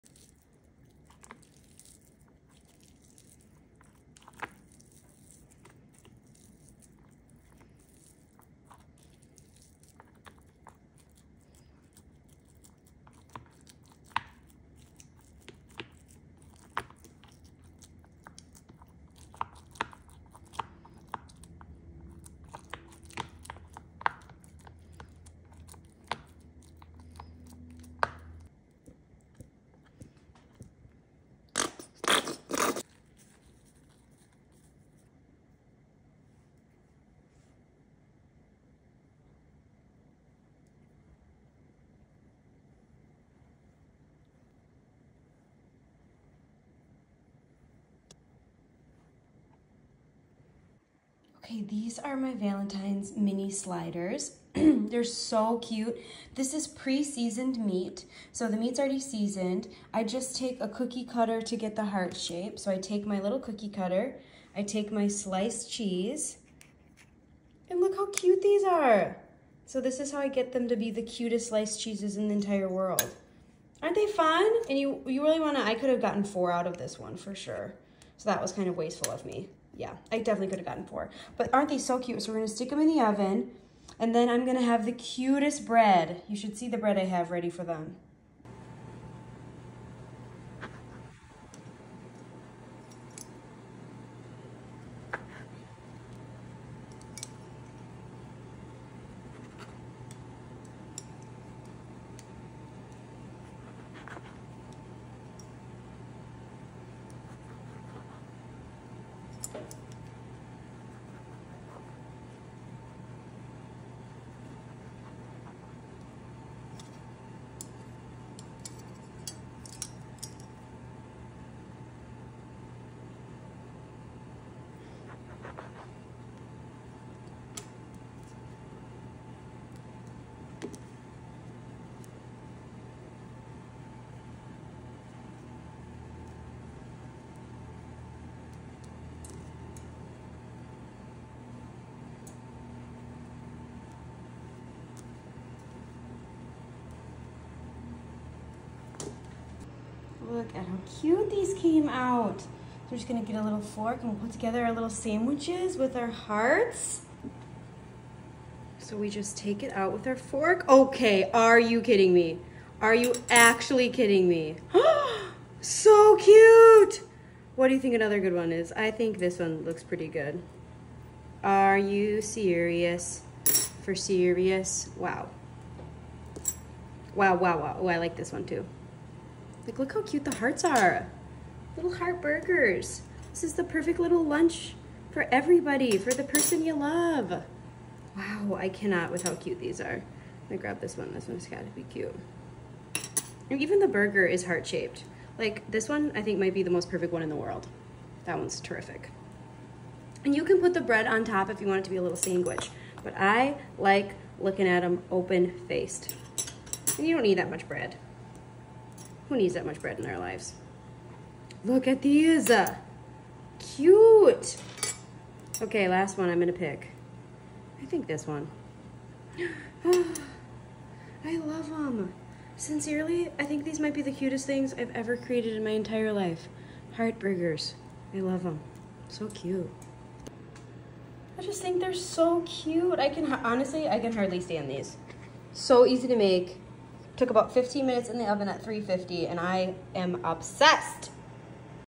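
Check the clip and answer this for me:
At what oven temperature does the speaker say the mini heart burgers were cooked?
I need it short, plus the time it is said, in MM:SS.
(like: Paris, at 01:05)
350, at 03:58.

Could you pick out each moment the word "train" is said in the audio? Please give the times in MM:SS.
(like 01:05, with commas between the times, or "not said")
not said.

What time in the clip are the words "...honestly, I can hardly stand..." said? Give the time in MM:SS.
03:53.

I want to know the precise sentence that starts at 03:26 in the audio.
And you don't need that much bread.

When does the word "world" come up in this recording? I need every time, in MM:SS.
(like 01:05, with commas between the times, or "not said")
01:12, 03:17.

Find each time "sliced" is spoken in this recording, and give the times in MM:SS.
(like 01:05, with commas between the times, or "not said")
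01:05, 01:11.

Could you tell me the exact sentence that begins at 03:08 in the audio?
Wow, I cannot with how cute these are.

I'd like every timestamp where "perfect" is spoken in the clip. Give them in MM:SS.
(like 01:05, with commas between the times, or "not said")
03:03, 03:16.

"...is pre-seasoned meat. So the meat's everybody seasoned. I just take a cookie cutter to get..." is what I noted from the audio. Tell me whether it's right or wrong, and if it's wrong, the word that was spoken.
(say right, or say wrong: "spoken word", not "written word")
wrong: "already", not "everybody".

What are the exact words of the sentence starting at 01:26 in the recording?
You should see the bread I have ready for them.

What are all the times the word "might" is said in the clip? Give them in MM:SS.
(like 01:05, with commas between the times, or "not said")
03:16, 03:43.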